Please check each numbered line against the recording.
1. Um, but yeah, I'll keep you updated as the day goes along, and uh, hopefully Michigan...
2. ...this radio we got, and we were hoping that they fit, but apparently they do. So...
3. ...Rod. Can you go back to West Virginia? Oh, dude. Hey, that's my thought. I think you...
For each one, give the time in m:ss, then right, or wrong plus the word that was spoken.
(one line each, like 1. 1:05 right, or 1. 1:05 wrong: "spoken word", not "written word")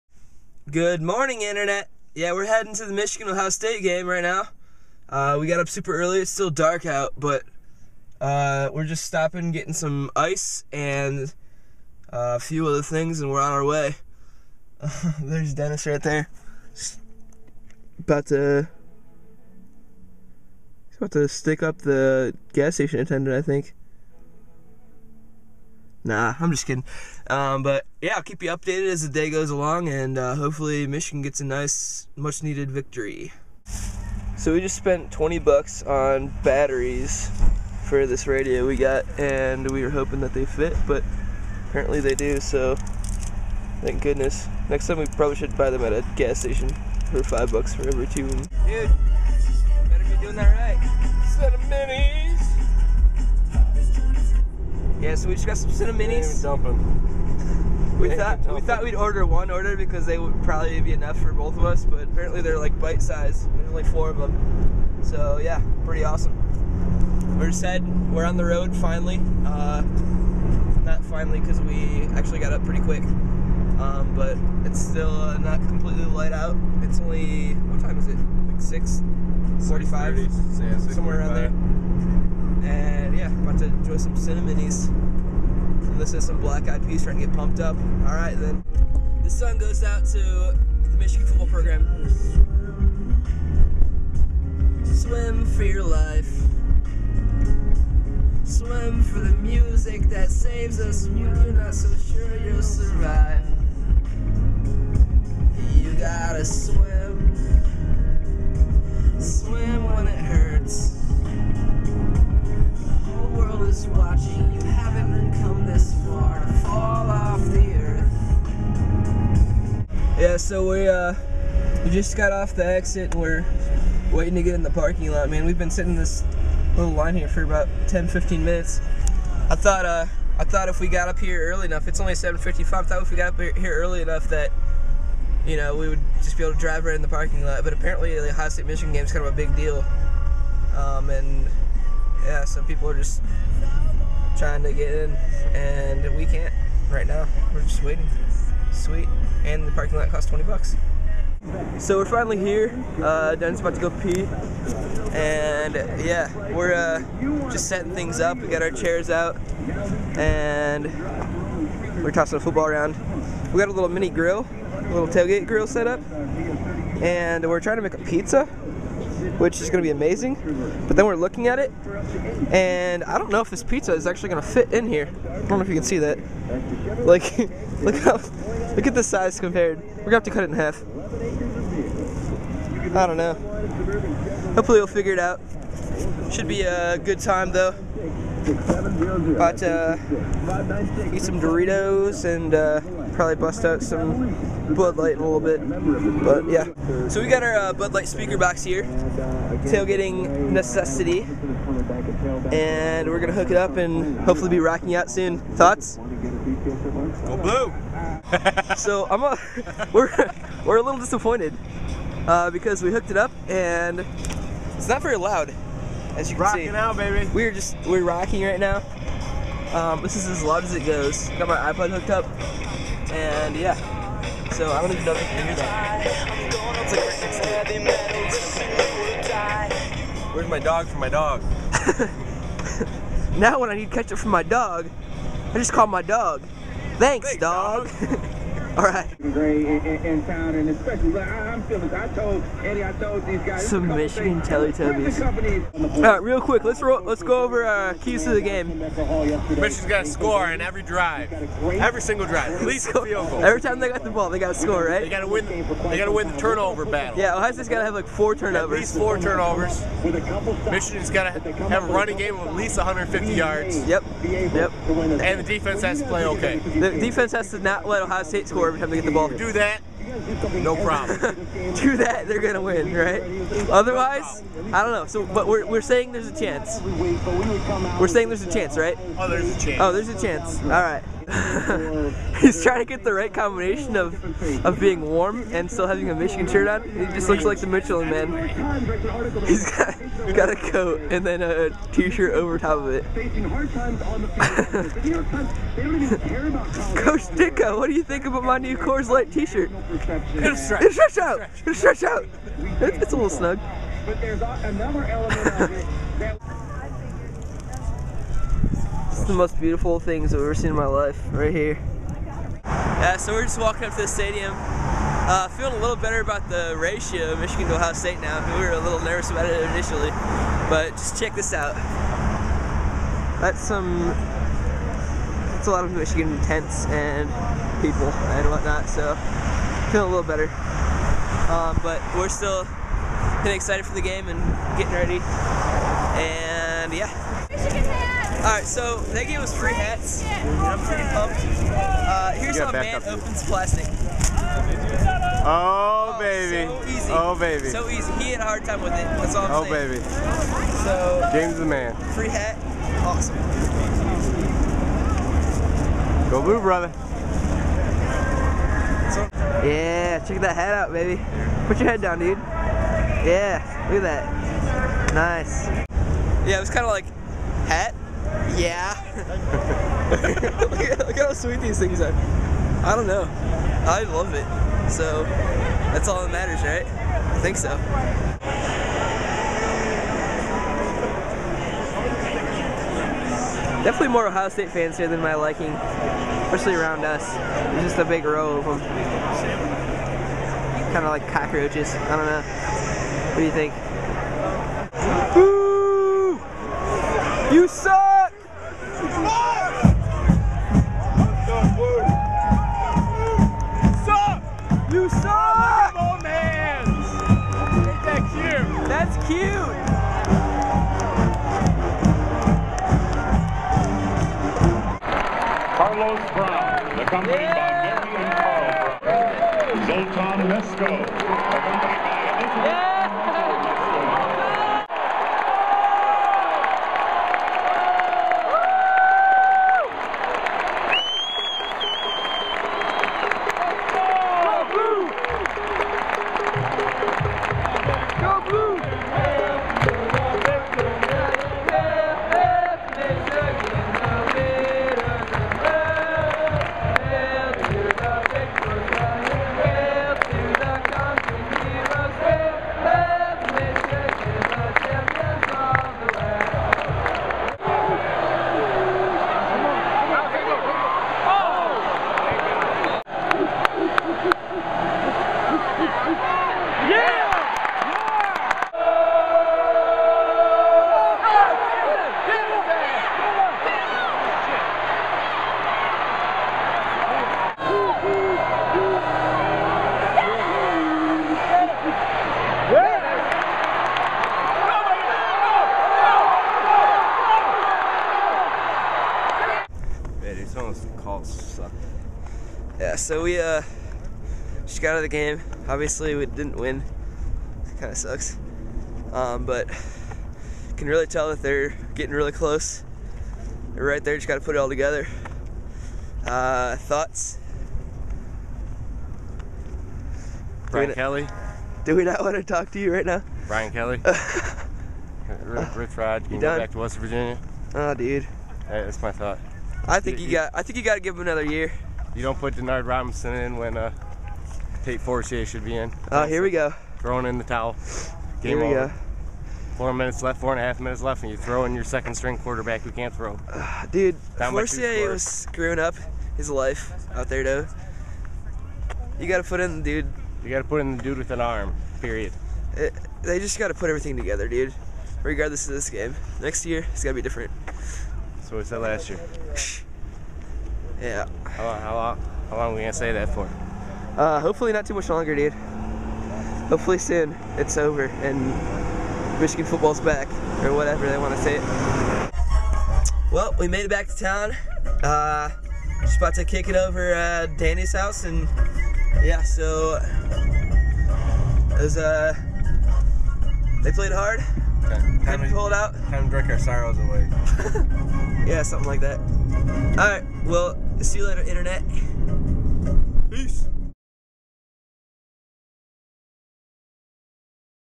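1. 0:27 right
2. 0:38 right
3. 8:35 right.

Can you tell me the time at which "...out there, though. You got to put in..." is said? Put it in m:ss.
8:57.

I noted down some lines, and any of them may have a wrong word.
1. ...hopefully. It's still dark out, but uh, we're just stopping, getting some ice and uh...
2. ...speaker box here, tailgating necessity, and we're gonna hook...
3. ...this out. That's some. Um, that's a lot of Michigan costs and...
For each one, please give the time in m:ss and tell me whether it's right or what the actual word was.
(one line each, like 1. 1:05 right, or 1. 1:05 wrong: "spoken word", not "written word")
1. 0:05 wrong: "early", not "hopefully"
2. 3:18 right
3. 5:21 wrong: "tents", not "costs".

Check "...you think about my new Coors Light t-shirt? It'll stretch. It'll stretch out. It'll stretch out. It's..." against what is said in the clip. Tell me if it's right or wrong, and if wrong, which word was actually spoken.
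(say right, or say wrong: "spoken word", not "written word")
right.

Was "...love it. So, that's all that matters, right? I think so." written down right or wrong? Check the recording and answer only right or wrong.
right.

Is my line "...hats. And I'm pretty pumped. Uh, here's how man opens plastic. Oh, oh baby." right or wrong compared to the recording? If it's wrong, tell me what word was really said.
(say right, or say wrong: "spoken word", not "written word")
right.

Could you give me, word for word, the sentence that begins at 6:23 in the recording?
Definitely more Ohio State fans here than my liking especially around us.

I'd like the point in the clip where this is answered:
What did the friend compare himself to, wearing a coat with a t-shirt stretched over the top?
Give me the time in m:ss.
4:47.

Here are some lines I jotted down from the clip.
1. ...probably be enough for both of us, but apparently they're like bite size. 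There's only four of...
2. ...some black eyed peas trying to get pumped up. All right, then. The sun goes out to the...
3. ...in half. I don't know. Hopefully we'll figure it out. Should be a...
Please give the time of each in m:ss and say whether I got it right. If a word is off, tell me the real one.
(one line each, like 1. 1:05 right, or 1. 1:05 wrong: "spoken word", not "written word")
1. 1:00 right
2. 1:26 right
3. 3:00 right.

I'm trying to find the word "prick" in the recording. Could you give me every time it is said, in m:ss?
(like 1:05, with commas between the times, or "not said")
not said.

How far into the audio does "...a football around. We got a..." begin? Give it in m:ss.
2:42.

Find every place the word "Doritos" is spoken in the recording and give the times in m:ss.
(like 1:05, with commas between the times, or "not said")
3:11.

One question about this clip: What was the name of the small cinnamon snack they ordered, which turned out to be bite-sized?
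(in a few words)
Cini-minis.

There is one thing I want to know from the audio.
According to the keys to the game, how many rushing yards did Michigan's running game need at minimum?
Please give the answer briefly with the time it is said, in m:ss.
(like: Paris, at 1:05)
150 yards, at 4:22.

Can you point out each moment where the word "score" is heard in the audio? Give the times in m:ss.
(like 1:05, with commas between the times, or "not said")
4:10, 4:14, 4:28.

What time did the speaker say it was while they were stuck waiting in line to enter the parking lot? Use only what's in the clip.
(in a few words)
7:55.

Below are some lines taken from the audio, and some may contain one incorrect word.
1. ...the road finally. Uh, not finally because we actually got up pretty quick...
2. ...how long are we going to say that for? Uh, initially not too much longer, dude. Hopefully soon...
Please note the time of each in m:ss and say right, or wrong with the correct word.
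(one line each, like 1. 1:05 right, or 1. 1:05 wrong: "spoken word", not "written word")
1. 1:08 right
2. 9:12 wrong: "hopefully", not "initially".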